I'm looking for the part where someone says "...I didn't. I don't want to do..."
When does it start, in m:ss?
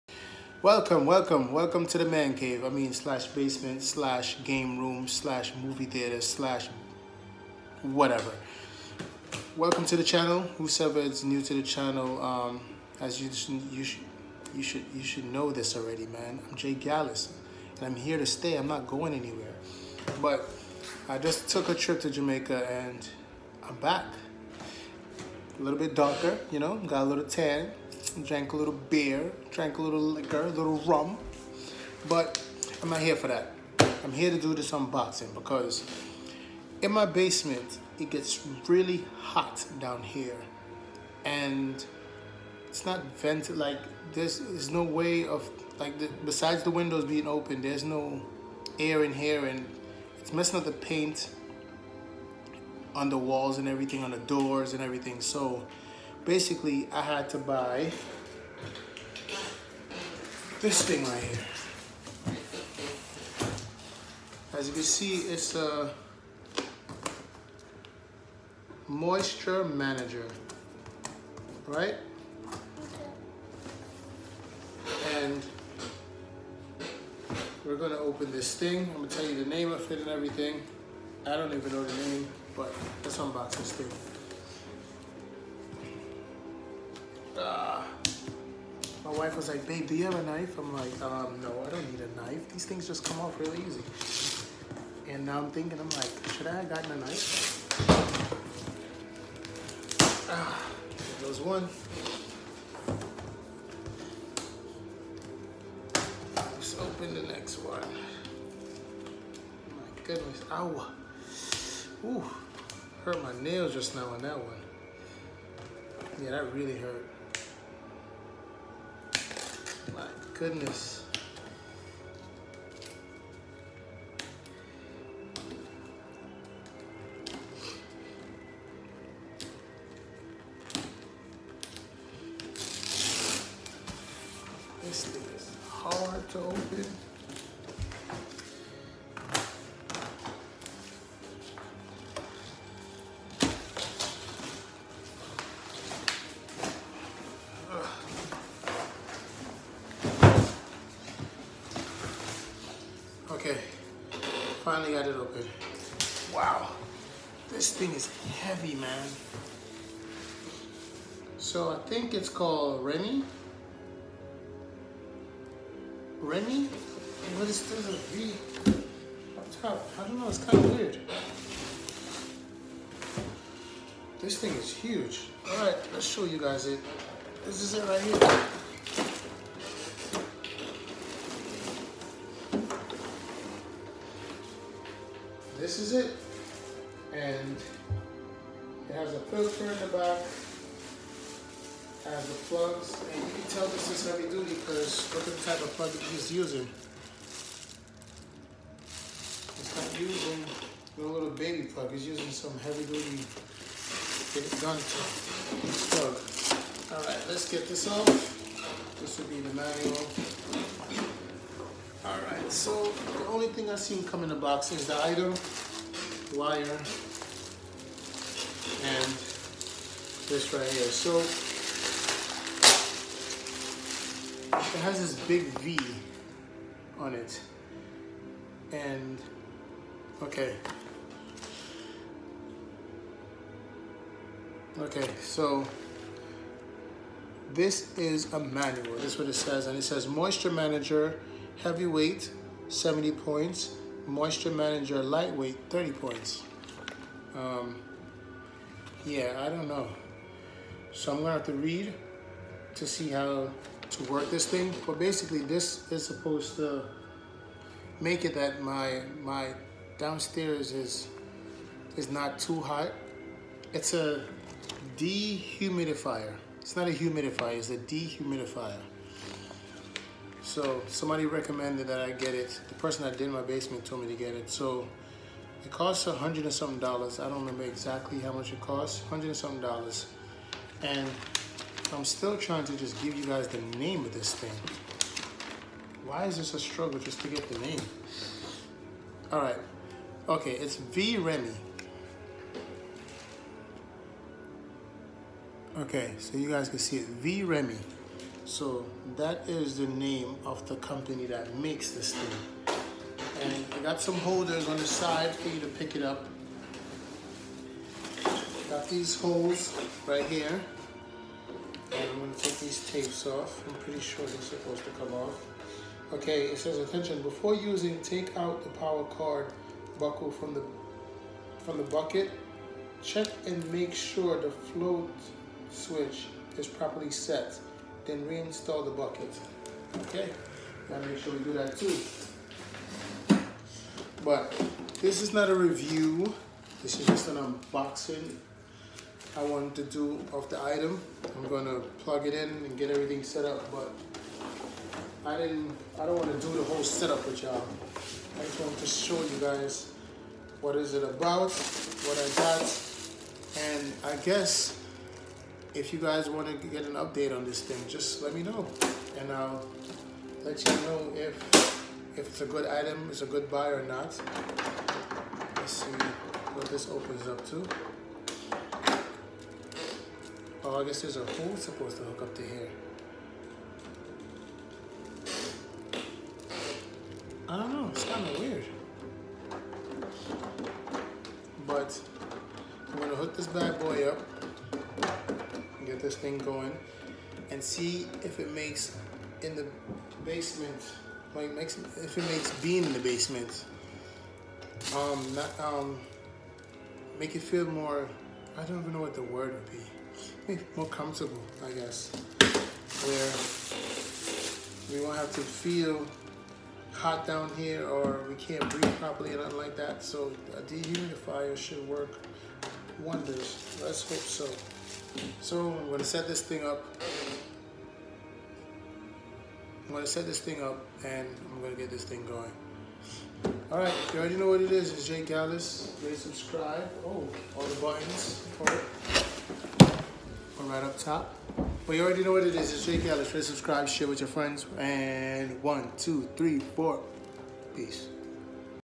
5:45.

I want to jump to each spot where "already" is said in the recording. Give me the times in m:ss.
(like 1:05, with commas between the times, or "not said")
0:15, 7:04, 7:12.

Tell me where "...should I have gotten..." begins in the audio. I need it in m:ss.
1:36.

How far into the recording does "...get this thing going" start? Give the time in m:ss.
7:01.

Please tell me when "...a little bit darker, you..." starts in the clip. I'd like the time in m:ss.
0:25.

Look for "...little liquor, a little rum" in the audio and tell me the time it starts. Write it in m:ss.
0:29.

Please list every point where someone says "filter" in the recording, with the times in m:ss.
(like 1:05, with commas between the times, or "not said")
3:09.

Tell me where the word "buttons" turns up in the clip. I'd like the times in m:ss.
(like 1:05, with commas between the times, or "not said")
7:07.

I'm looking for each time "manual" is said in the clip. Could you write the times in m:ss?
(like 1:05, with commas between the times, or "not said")
3:29, 3:58.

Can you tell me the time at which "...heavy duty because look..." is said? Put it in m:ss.
3:14.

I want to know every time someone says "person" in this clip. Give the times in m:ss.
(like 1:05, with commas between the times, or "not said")
4:32.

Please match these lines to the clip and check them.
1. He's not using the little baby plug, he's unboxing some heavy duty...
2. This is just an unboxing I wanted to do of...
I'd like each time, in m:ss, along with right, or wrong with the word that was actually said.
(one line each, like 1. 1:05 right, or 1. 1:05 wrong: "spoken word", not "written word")
1. 3:19 wrong: "using", not "unboxing"
2. 5:36 right.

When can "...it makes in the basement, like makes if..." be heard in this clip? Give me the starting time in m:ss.
6:28.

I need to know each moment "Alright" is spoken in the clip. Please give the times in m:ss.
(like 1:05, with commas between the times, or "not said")
3:26, 3:32.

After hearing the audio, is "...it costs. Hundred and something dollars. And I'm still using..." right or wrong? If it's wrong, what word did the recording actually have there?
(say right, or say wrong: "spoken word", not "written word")
wrong: "trying", not "using".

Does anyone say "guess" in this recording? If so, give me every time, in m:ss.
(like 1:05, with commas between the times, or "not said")
5:54, 6:10, 6:41.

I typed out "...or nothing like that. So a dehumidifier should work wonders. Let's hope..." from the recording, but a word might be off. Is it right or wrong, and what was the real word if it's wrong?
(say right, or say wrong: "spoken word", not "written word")
right.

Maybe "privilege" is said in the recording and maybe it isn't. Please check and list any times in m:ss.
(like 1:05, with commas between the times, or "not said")
not said.